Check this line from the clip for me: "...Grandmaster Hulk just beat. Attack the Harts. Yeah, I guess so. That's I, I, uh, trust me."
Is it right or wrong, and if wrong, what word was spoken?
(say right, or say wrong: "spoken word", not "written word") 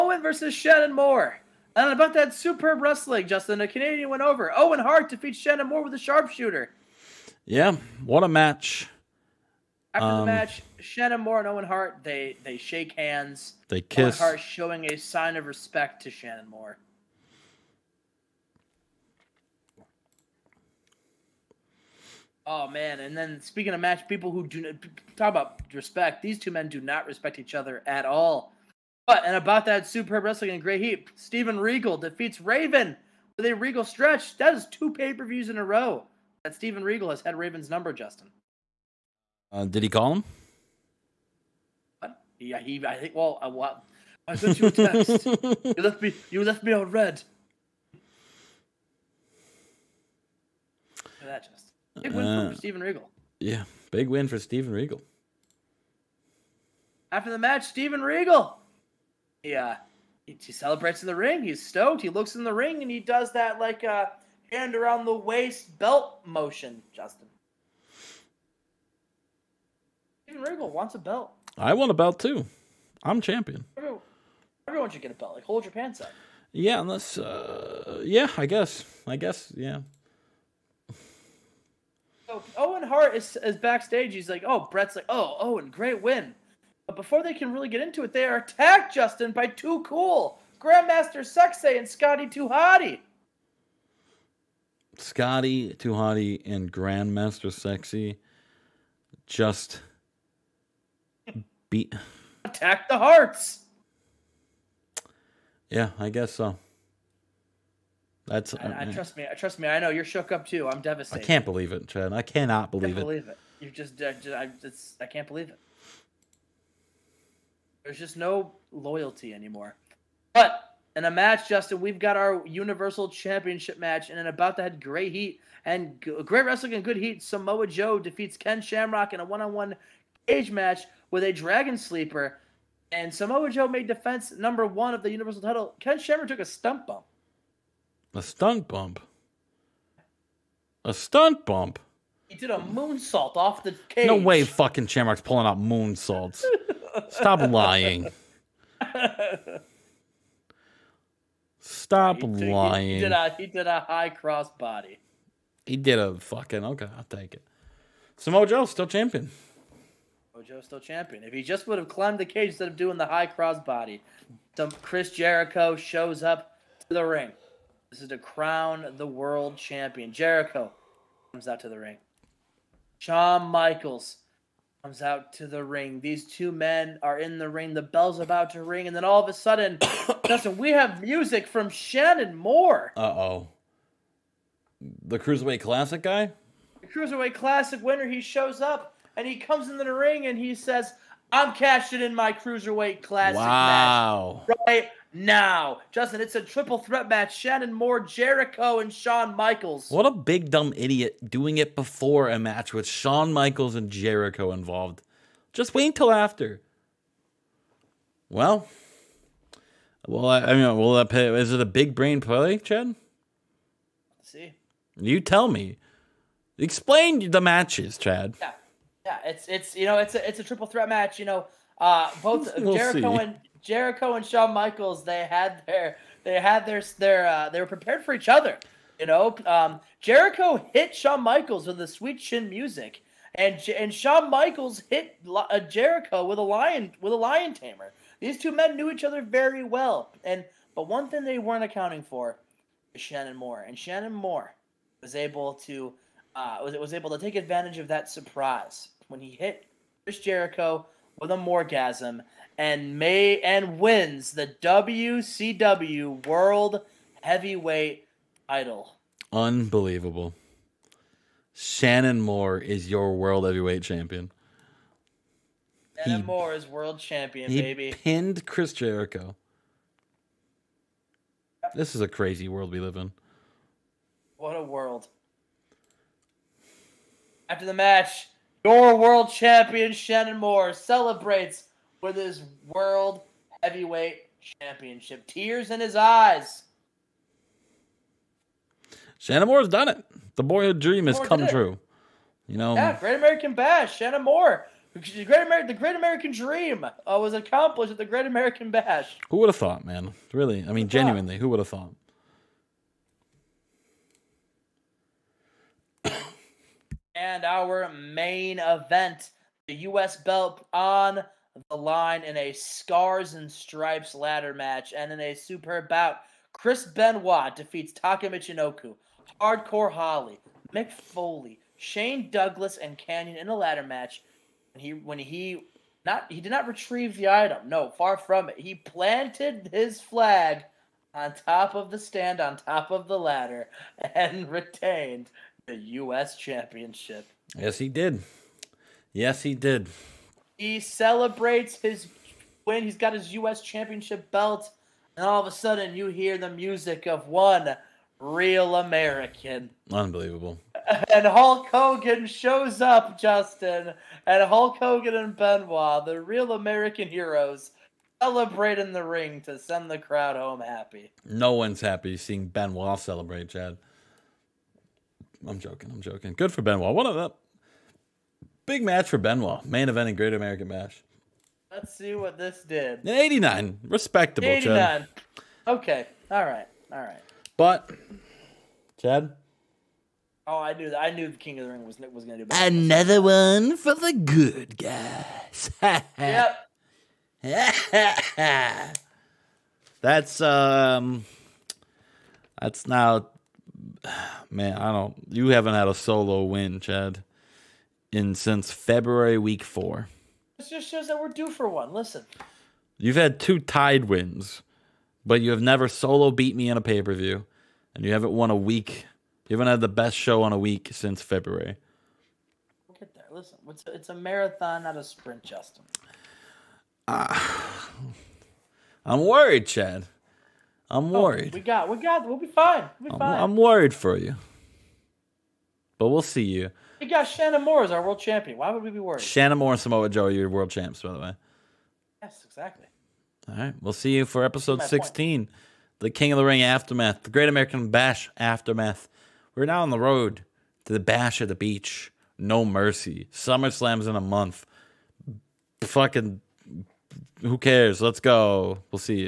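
wrong: "Sexay", not "Hulk".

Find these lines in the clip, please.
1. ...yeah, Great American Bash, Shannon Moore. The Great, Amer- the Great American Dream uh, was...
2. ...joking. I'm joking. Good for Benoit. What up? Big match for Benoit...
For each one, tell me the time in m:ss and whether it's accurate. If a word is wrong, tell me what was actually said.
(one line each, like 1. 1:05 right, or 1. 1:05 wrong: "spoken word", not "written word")
1. 4:52 right
2. 6:05 right.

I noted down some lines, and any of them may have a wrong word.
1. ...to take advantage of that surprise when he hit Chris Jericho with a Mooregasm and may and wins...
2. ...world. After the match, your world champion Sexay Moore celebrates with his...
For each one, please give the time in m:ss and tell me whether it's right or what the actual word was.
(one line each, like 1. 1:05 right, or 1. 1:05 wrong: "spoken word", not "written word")
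1. 4:07 right
2. 4:34 wrong: "Shannon", not "Sexay".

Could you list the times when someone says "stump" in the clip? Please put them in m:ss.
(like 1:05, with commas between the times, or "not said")
2:16.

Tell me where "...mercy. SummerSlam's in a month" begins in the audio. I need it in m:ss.
7:22.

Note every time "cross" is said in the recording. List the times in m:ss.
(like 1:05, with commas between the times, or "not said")
2:34, 2:43.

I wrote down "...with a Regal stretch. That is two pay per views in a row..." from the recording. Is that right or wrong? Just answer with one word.
right.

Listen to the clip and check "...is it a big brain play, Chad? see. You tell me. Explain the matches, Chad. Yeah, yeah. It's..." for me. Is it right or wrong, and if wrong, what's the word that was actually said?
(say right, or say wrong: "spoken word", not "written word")
right.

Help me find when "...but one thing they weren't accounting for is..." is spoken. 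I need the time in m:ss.
4:00.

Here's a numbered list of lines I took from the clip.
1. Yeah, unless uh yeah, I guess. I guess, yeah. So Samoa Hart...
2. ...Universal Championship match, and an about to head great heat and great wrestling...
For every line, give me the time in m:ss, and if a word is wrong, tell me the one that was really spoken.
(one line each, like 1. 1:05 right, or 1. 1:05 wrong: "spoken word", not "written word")
1. 1:16 wrong: "Owen", not "Samoa"
2. 2:02 right.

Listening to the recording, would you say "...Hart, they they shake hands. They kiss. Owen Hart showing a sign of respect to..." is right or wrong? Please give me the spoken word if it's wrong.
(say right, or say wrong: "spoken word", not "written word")
right.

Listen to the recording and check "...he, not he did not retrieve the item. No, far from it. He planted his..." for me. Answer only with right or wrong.
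right.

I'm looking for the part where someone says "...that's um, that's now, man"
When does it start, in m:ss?
6:30.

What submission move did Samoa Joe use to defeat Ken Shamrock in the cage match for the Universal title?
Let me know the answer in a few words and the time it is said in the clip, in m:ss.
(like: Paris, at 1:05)
Dragon Sleeper, at 2:11.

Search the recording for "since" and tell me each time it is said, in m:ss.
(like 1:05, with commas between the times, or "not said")
6:38, 6:50.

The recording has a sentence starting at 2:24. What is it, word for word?
No way, fucking Shamrock's pulling out moonsaults.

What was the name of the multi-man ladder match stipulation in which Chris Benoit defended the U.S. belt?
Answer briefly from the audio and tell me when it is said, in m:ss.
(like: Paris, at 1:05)
Scars and Stripes, at 5:12.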